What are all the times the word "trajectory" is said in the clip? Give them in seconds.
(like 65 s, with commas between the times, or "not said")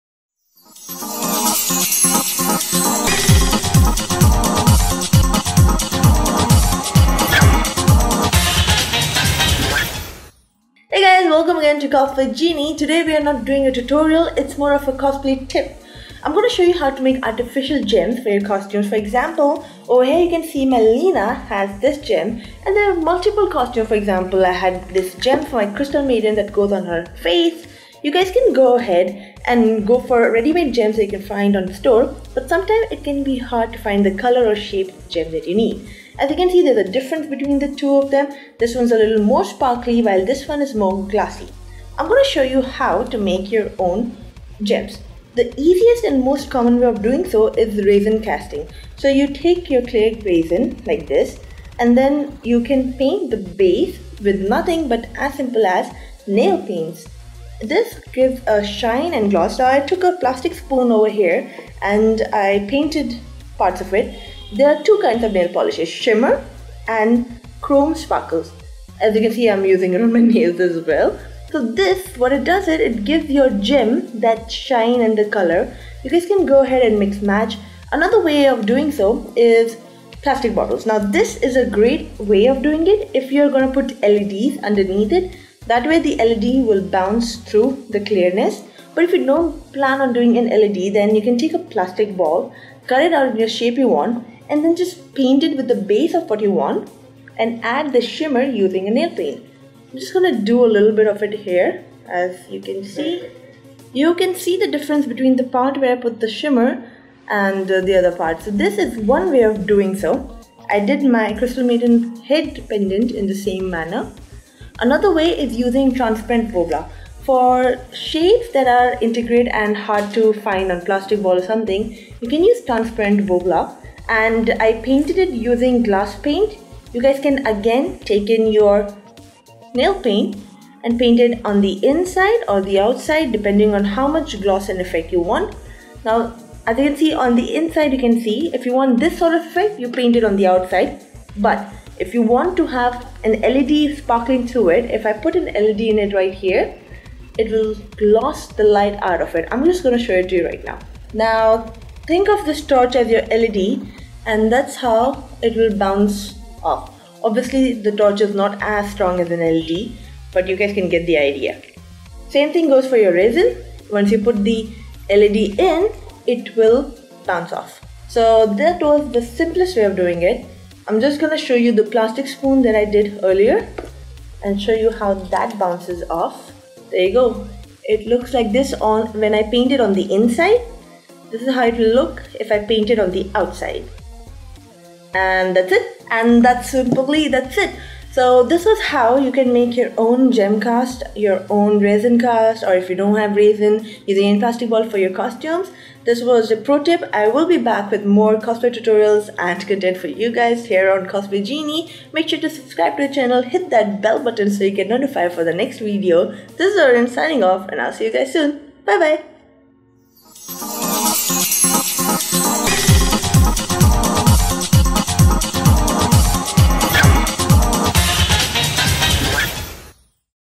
not said.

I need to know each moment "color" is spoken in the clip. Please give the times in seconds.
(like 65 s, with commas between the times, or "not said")
34 s, 75 s.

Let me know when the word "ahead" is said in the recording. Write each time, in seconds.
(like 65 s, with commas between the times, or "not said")
28 s, 76 s.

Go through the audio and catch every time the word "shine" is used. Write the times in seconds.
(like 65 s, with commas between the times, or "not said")
58 s, 74 s.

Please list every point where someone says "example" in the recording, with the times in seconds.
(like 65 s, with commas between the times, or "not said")
18 s, 23 s.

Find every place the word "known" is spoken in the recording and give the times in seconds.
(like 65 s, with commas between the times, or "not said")
not said.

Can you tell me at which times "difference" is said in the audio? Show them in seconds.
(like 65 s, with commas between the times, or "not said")
36 s, 104 s.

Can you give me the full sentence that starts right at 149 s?
I'm just going to show it to you right now.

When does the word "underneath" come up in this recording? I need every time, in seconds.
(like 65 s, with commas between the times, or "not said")
84 s.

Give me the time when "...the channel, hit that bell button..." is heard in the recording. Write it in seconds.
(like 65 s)
203 s.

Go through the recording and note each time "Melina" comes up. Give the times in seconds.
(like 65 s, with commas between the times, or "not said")
20 s.